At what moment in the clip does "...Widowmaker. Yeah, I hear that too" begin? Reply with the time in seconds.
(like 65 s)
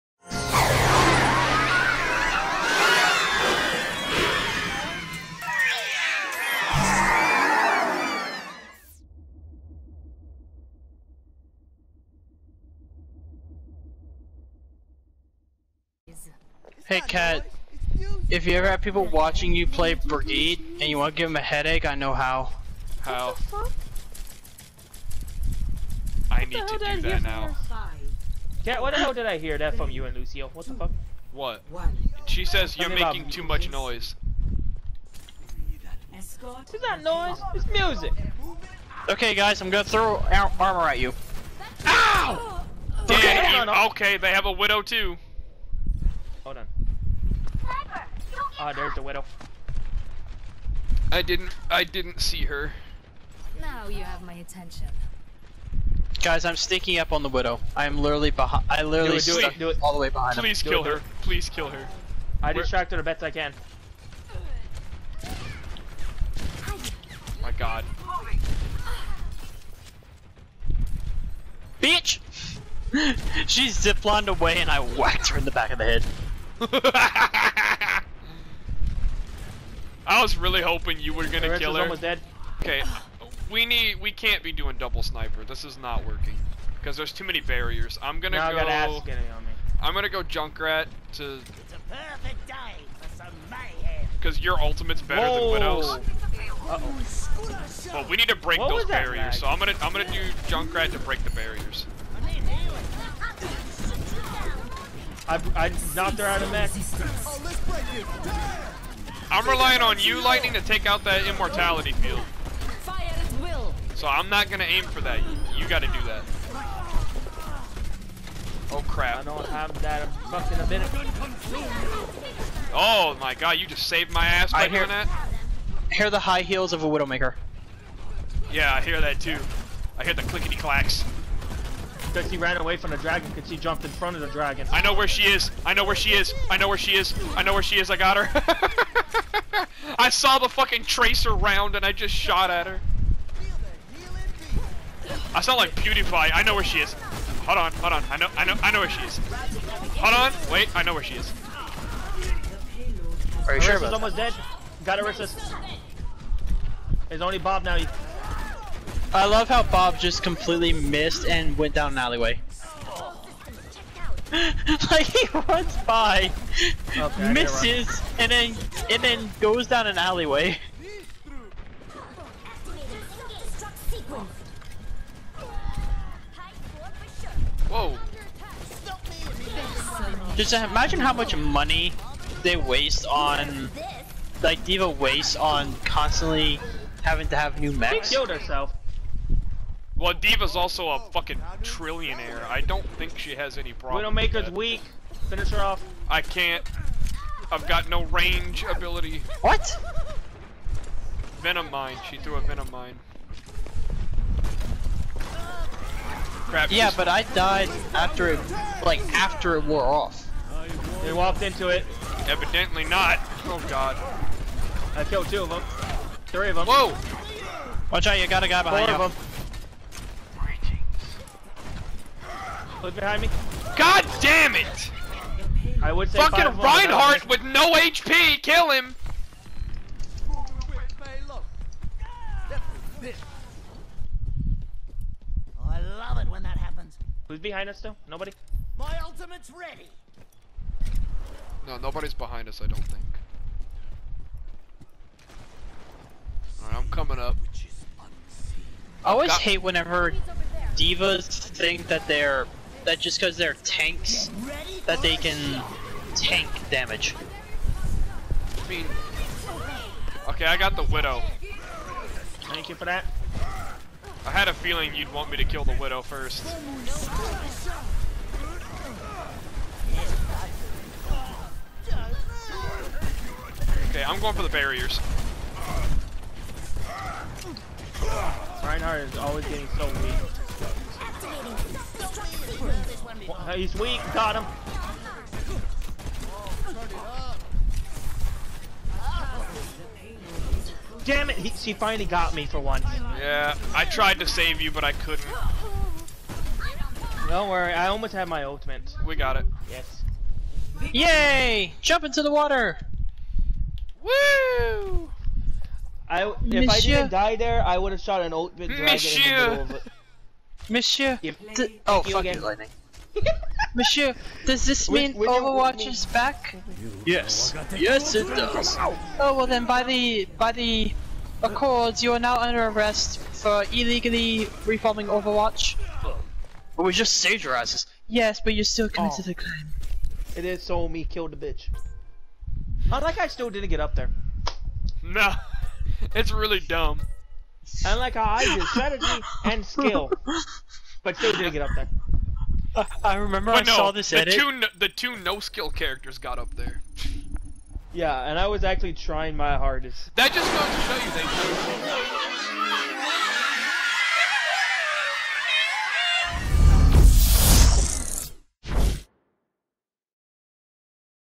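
126 s.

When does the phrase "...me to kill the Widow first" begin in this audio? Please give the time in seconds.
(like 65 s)
265 s.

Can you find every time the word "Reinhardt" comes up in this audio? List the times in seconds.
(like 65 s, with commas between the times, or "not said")
226 s, 278 s.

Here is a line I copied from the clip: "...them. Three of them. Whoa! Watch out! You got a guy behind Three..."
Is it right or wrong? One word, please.
wrong.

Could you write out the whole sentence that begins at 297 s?
Don't worry, I almost had my ultimate.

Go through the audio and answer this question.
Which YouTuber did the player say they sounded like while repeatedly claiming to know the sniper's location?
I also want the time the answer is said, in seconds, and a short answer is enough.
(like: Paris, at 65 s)
PewDiePie, at 145 s.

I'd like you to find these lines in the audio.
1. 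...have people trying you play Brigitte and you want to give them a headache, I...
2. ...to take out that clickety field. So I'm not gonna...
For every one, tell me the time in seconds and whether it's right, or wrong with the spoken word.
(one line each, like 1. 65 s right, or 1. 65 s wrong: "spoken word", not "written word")
1. 18 s wrong: "watching", not "trying"
2. 110 s wrong: "immortality", not "clickety".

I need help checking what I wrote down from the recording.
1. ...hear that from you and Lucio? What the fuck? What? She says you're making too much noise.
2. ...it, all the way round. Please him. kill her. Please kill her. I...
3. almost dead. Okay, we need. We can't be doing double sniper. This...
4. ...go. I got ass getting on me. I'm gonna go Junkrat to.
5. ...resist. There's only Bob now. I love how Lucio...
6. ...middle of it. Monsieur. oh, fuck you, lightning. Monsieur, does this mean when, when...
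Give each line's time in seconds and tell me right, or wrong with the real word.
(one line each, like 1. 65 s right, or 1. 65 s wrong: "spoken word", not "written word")
1. 29 s right
2. 59 s wrong: "behind", not "round"
3. 81 s right
4. 88 s right
5. 155 s wrong: "Bob", not "Lucio"
6. 309 s right.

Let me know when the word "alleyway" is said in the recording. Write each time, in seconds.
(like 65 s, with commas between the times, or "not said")
161 s, 169 s.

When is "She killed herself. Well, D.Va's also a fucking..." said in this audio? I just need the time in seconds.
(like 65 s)
188 s.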